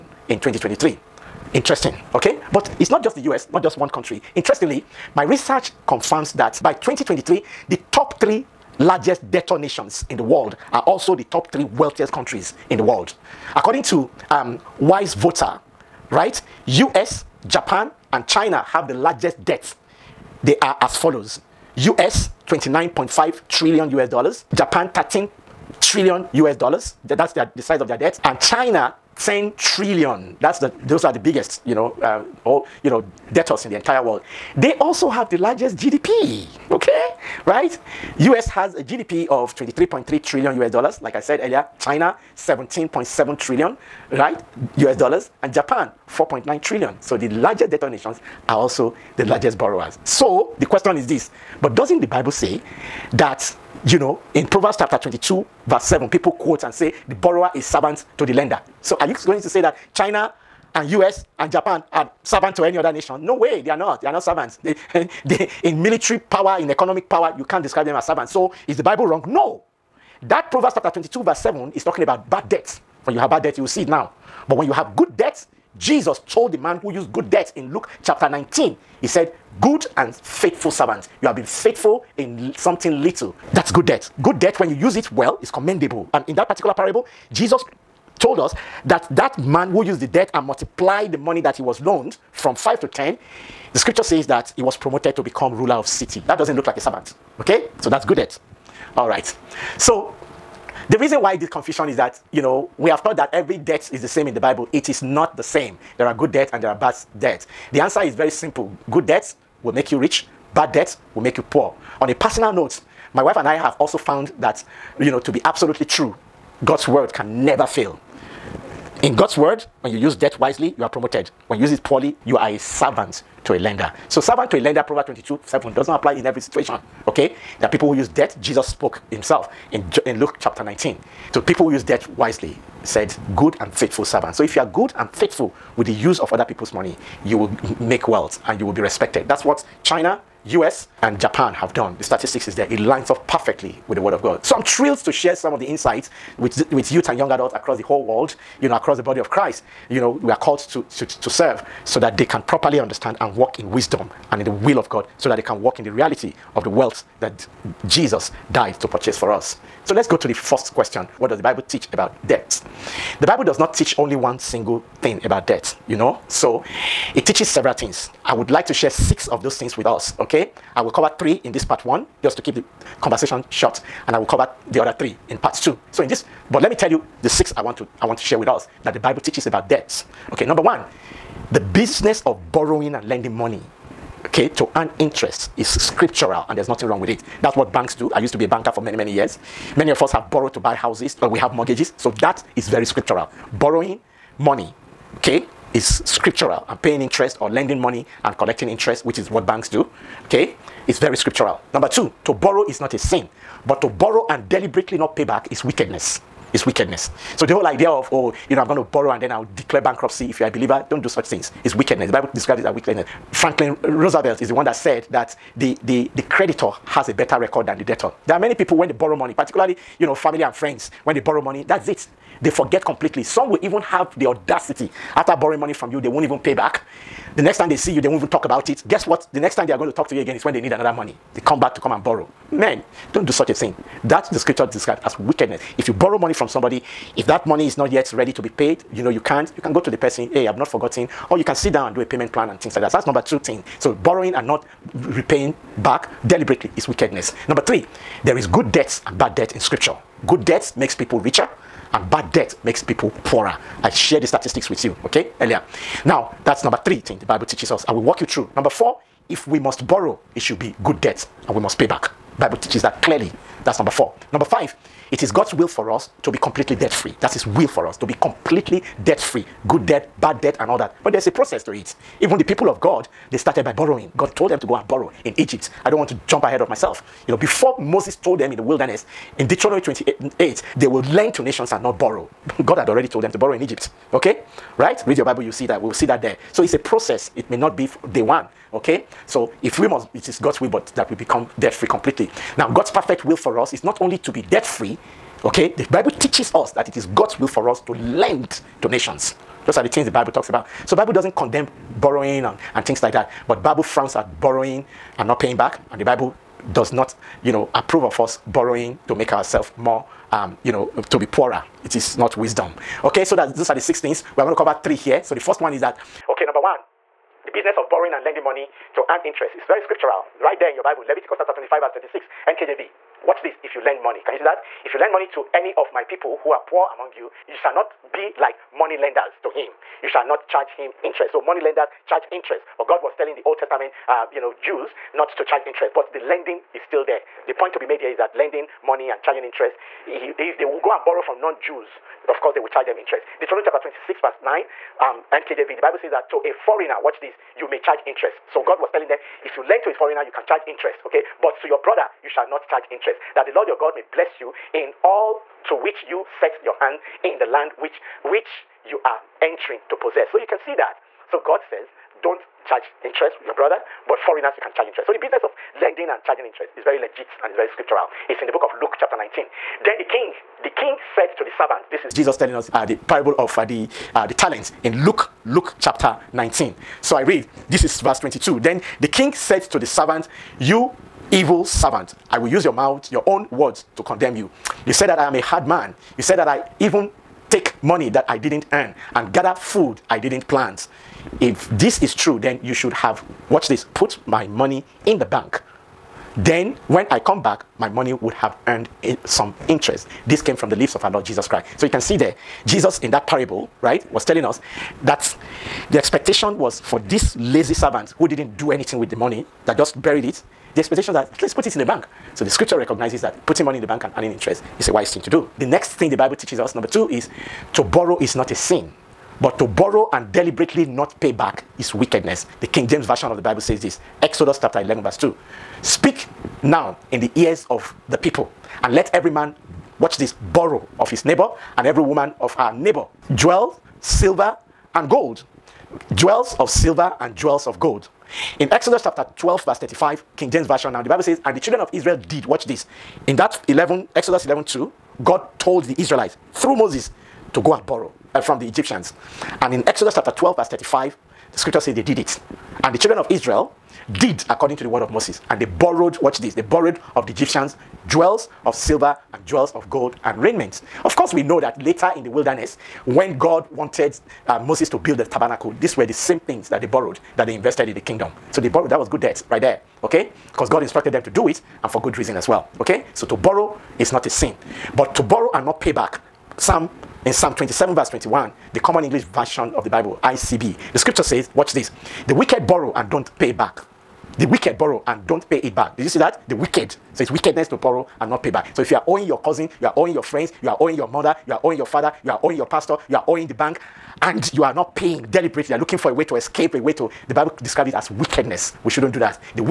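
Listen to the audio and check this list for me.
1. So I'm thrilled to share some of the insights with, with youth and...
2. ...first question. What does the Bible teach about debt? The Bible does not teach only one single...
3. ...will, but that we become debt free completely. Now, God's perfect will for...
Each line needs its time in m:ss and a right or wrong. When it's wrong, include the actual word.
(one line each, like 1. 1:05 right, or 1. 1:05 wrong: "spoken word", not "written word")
1. 2:24 right
2. 2:40 right
3. 4:50 right.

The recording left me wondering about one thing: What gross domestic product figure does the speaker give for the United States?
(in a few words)
23.3 trillion US dollars.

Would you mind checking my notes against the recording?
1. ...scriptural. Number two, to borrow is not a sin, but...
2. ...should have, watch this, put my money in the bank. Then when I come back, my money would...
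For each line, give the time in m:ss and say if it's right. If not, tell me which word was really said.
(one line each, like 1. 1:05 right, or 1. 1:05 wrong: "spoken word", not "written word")
1. 3:21 right
2. 6:32 right.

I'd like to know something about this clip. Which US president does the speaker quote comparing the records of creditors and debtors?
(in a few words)
Franklin Roosevelt.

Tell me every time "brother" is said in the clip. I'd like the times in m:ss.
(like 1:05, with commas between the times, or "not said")
5:51, 6:03.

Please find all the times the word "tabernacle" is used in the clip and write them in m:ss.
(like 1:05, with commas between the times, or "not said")
7:45.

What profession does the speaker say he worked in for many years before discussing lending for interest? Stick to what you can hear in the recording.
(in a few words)
banker.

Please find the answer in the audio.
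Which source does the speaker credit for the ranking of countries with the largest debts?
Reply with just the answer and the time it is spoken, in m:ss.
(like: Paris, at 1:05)
Wise Voter, at 0:14.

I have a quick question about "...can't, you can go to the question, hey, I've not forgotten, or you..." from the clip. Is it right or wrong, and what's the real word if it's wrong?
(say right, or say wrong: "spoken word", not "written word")
wrong: "person", not "question".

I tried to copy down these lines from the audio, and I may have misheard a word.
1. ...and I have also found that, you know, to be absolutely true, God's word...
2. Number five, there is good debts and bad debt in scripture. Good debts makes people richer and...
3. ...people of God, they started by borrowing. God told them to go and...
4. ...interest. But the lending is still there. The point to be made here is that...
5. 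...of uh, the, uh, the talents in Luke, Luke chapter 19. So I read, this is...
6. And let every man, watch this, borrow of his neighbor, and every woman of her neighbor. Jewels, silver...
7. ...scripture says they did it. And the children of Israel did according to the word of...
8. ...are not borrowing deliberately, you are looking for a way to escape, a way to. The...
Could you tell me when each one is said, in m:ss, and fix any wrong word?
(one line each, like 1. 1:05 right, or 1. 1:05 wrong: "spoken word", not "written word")
1. 1:53 right
2. 4:07 wrong: "three", not "five"
3. 4:32 right
4. 5:35 right
5. 6:13 right
6. 7:08 right
7. 7:31 right
8. 8:14 wrong: "paying", not "borrowing".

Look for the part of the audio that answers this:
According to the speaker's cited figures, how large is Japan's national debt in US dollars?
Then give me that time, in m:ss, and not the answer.
0:24.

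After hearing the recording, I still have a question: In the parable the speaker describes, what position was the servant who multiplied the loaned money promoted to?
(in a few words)
ruler of city.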